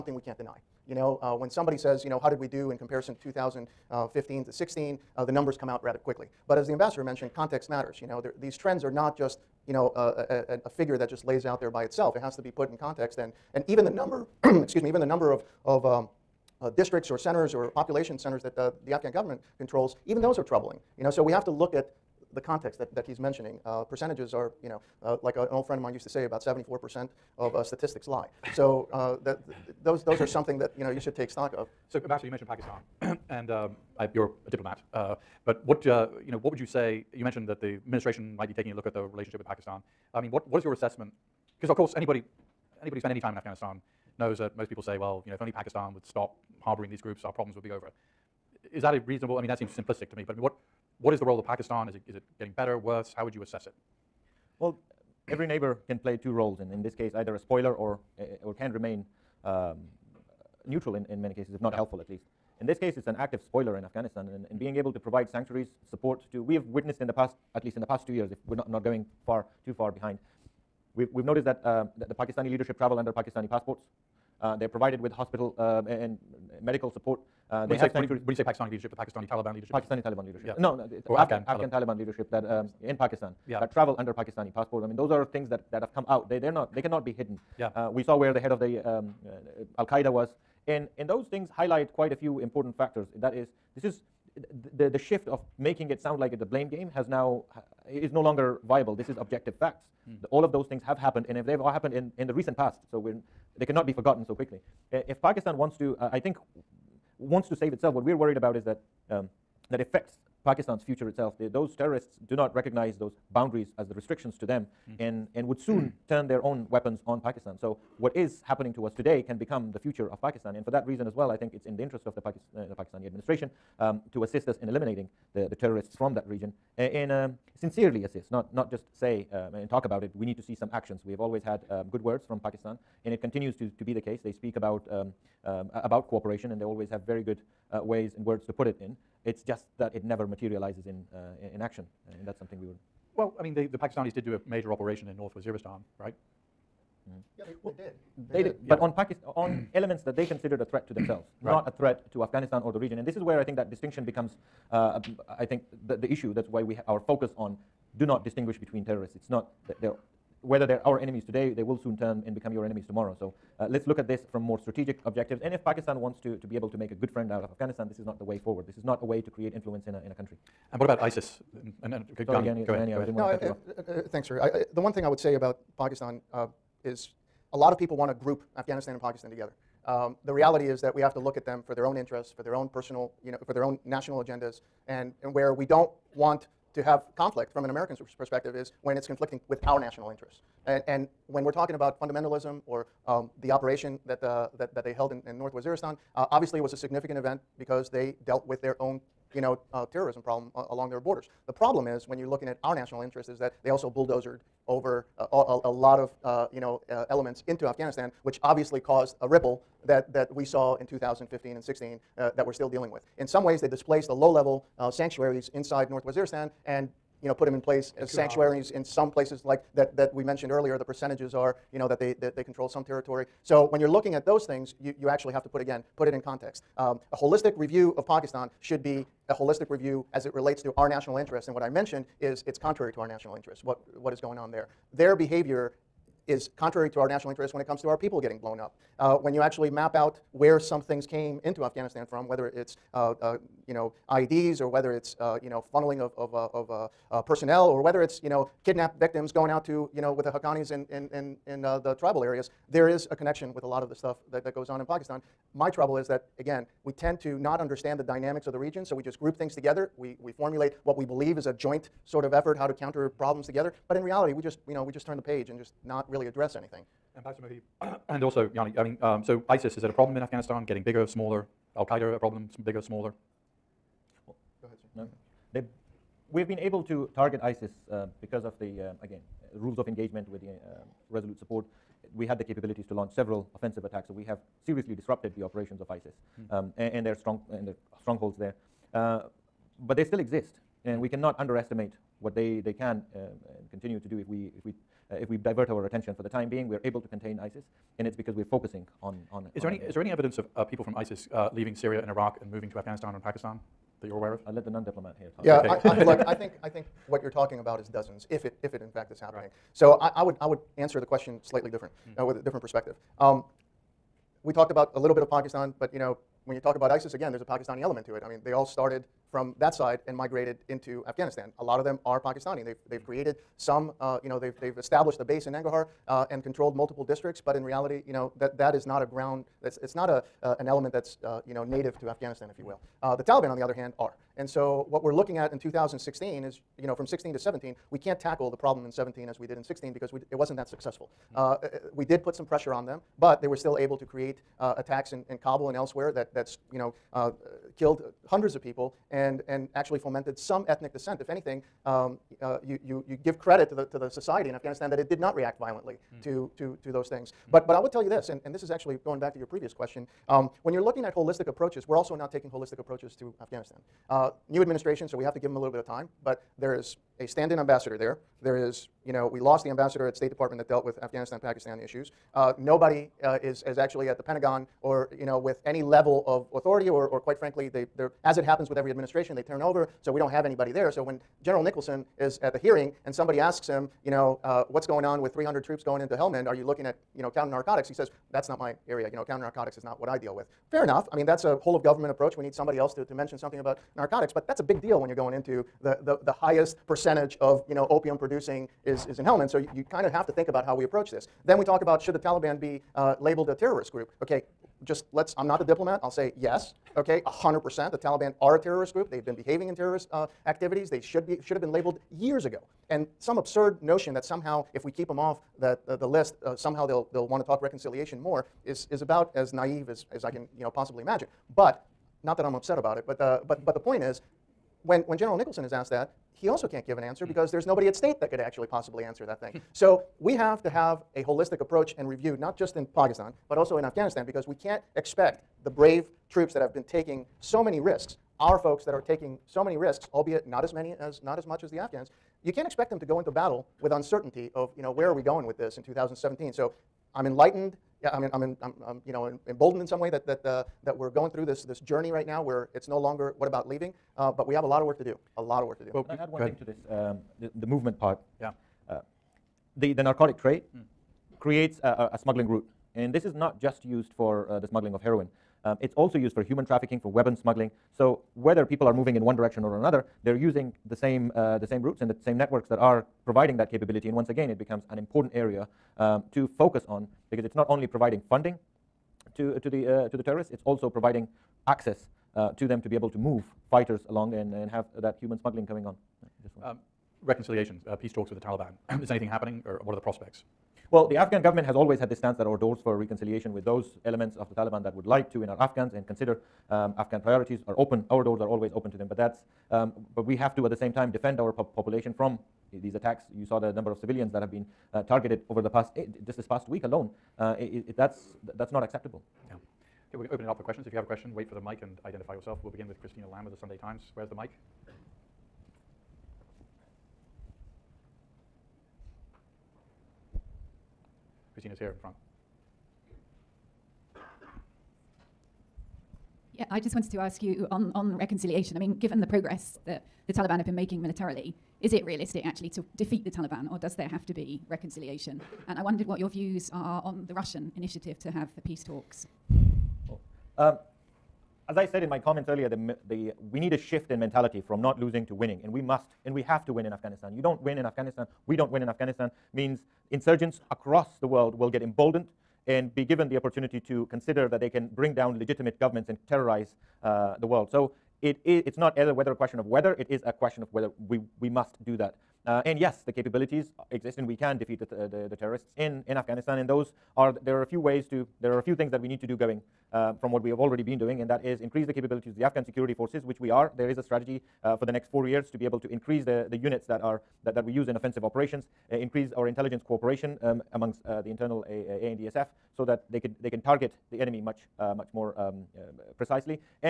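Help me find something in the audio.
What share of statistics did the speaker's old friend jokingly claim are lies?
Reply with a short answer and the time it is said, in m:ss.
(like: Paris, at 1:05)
74%, at 0:26.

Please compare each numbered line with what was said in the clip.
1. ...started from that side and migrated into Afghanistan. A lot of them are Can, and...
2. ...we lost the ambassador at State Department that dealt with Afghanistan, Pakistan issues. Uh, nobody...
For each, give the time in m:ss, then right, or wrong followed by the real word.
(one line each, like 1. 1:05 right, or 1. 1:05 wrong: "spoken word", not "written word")
1. 5:18 wrong: "Pakistani", not "Can"
2. 6:09 right.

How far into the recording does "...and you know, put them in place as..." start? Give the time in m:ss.
3:36.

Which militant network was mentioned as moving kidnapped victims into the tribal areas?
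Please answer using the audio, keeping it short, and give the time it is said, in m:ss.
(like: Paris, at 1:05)
The Haqqanis, at 4:10.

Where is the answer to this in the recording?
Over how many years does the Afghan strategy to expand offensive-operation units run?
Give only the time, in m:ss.
9:35.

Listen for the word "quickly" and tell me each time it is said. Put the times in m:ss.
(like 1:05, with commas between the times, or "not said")
0:05, 1:44.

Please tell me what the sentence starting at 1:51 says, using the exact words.
those terrorists do not recognize those boundaries as the restrictions to them, mm.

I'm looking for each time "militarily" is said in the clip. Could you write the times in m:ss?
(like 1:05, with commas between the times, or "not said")
8:51.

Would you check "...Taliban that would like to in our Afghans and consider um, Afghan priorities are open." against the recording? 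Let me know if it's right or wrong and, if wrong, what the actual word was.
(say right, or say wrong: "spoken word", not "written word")
right.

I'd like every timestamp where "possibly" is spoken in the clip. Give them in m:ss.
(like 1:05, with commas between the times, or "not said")
7:00, 7:08.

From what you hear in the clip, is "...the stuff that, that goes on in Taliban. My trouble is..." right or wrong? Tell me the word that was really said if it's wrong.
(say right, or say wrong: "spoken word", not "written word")
wrong: "Pakistan", not "Taliban".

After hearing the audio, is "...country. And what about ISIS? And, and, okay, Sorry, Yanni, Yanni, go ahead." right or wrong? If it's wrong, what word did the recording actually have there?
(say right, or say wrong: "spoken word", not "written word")
right.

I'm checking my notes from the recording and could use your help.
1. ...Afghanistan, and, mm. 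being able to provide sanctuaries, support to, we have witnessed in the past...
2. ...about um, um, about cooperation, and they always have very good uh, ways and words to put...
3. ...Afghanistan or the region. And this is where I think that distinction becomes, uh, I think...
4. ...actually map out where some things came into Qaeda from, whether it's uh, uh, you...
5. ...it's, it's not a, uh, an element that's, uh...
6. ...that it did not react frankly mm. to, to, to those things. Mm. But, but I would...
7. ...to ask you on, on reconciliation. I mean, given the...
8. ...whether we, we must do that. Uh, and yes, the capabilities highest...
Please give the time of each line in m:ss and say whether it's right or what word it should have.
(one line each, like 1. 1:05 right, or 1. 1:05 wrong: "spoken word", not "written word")
1. 1:03 right
2. 2:14 right
3. 2:32 right
4. 3:59 wrong: "Afghanistan", not "Qaeda"
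5. 5:29 right
6. 5:54 wrong: "violently", not "frankly"
7. 8:47 right
8. 9:20 wrong: "exist", not "highest".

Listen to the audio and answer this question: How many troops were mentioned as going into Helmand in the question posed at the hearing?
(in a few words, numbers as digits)
300.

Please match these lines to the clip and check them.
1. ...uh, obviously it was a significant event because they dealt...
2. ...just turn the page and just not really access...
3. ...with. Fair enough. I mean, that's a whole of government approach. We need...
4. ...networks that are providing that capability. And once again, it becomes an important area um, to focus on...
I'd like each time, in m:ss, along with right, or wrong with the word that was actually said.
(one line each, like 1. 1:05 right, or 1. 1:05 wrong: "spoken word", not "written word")
1. 3:16 right
2. 4:24 wrong: "address", not "access"
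3. 6:30 right
4. 7:52 right.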